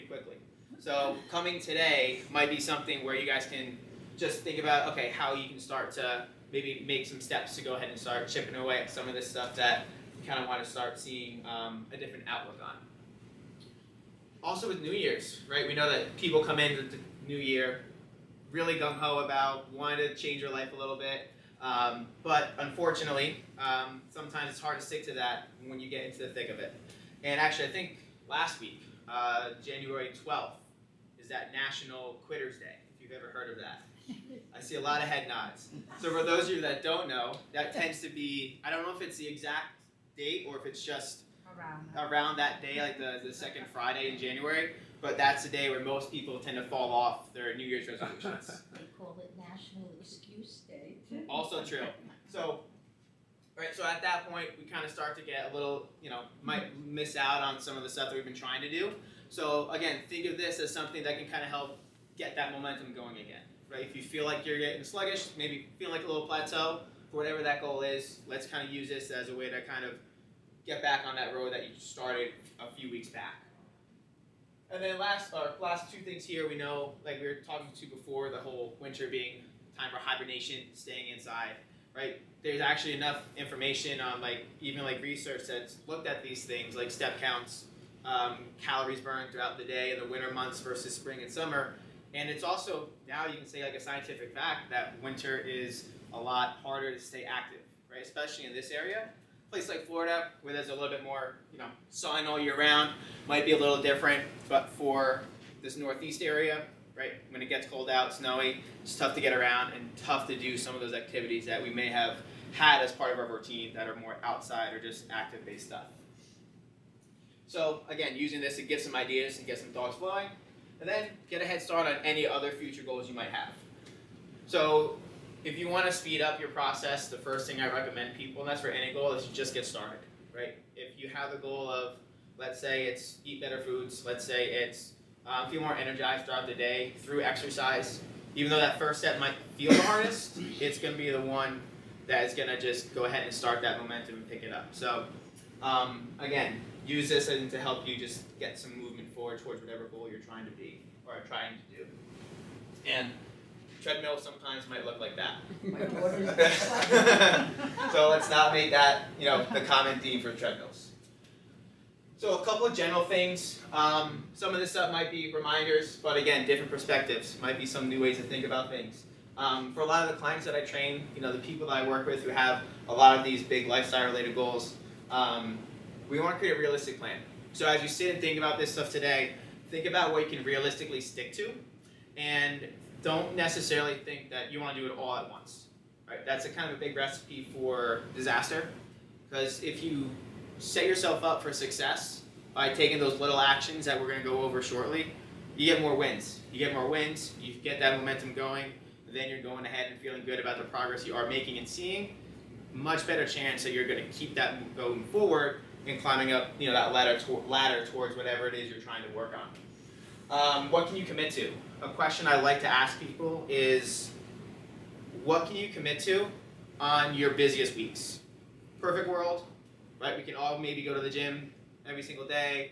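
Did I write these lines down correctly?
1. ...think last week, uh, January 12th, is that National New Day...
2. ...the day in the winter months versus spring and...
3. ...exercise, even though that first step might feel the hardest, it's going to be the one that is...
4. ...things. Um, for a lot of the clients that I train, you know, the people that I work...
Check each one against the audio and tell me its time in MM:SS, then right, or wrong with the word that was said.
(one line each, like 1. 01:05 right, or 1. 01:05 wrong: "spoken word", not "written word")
1. 00:27 wrong: "Quitters", not "New"
2. 01:29 right
3. 02:17 right
4. 02:48 right.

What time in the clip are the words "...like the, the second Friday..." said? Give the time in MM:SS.
00:42.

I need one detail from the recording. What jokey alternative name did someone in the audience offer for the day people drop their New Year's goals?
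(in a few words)
National Excuse Day.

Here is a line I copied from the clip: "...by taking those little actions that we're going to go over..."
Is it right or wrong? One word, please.
right.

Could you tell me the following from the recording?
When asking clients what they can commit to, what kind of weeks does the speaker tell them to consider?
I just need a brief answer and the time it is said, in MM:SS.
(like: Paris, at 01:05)
busiest weeks, at 03:37.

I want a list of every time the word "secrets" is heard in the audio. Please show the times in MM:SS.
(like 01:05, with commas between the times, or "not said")
not said.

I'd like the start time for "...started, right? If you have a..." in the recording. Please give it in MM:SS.
02:09.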